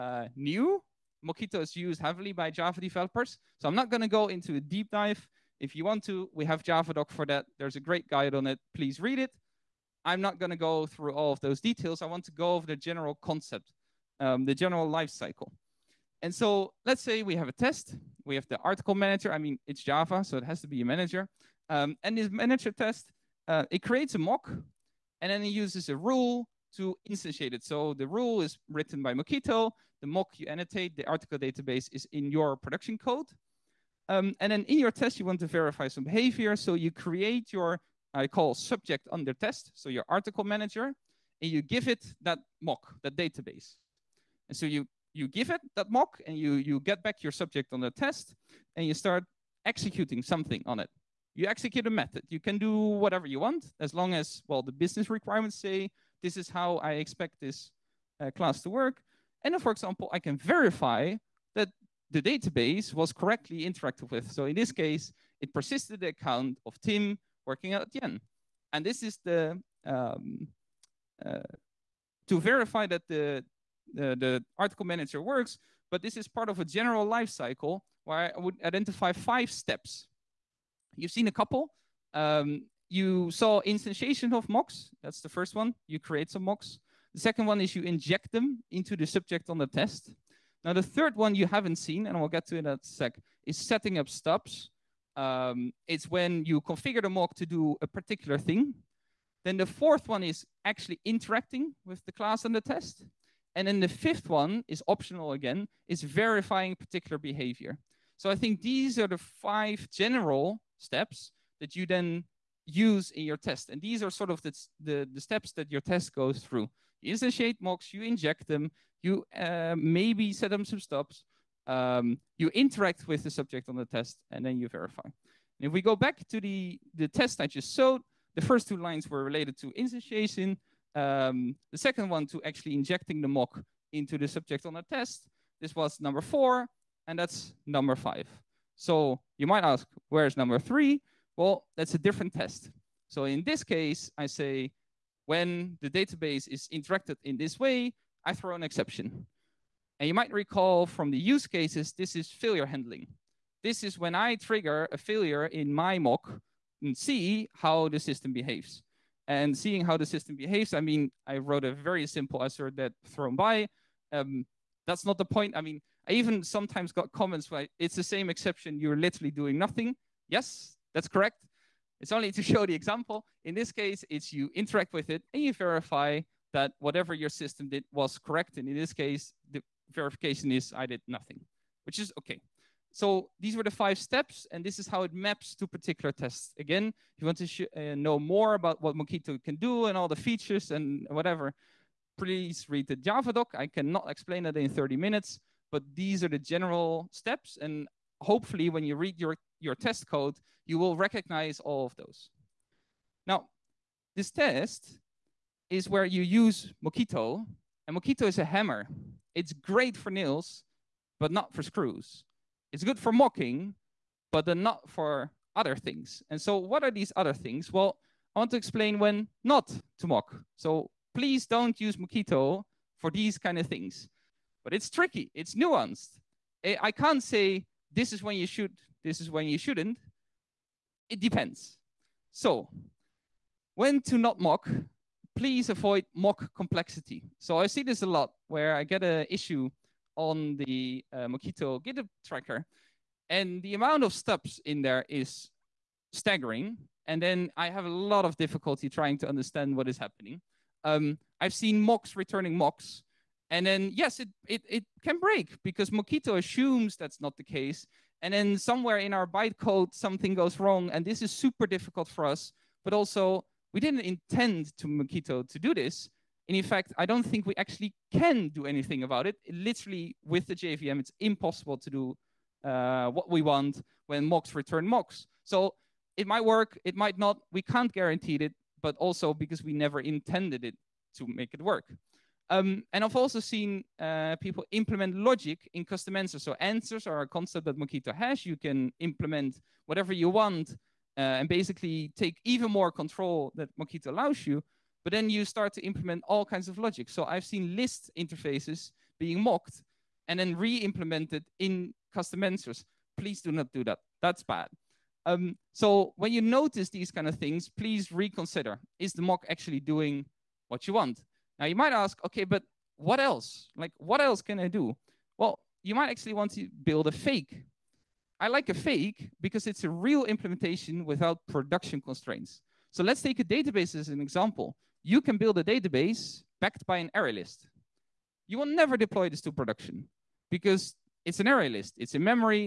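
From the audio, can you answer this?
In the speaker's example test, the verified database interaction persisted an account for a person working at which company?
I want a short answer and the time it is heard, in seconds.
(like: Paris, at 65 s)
Adyen, at 67 s.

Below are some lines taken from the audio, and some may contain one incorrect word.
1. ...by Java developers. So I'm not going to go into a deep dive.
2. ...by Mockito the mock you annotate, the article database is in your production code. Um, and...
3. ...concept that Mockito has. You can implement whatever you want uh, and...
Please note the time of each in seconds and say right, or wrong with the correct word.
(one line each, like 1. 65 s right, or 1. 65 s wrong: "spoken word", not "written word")
1. 2 s right
2. 29 s right
3. 287 s right.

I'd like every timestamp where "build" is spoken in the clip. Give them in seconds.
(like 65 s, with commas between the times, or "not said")
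316 s, 325 s.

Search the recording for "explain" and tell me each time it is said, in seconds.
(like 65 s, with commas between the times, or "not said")
194 s, 218 s.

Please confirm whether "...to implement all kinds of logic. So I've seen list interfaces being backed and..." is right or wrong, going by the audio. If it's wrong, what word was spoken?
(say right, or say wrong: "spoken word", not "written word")
wrong: "mocked", not "backed".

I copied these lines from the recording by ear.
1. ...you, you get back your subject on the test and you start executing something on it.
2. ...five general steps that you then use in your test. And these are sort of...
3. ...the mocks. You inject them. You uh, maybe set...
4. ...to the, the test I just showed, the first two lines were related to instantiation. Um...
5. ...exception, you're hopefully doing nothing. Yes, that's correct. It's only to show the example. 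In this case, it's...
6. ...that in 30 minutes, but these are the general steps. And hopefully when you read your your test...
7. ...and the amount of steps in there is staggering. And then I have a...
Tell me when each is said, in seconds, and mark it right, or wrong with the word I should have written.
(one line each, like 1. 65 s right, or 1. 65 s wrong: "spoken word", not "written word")
1. 46 s right
2. 109 s right
3. 117 s right
4. 126 s right
5. 168 s wrong: "literally", not "hopefully"
6. 194 s right
7. 243 s right.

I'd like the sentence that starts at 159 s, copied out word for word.
And seeing how the system behaves, I mean, I wrote a very simple assert that thrown by.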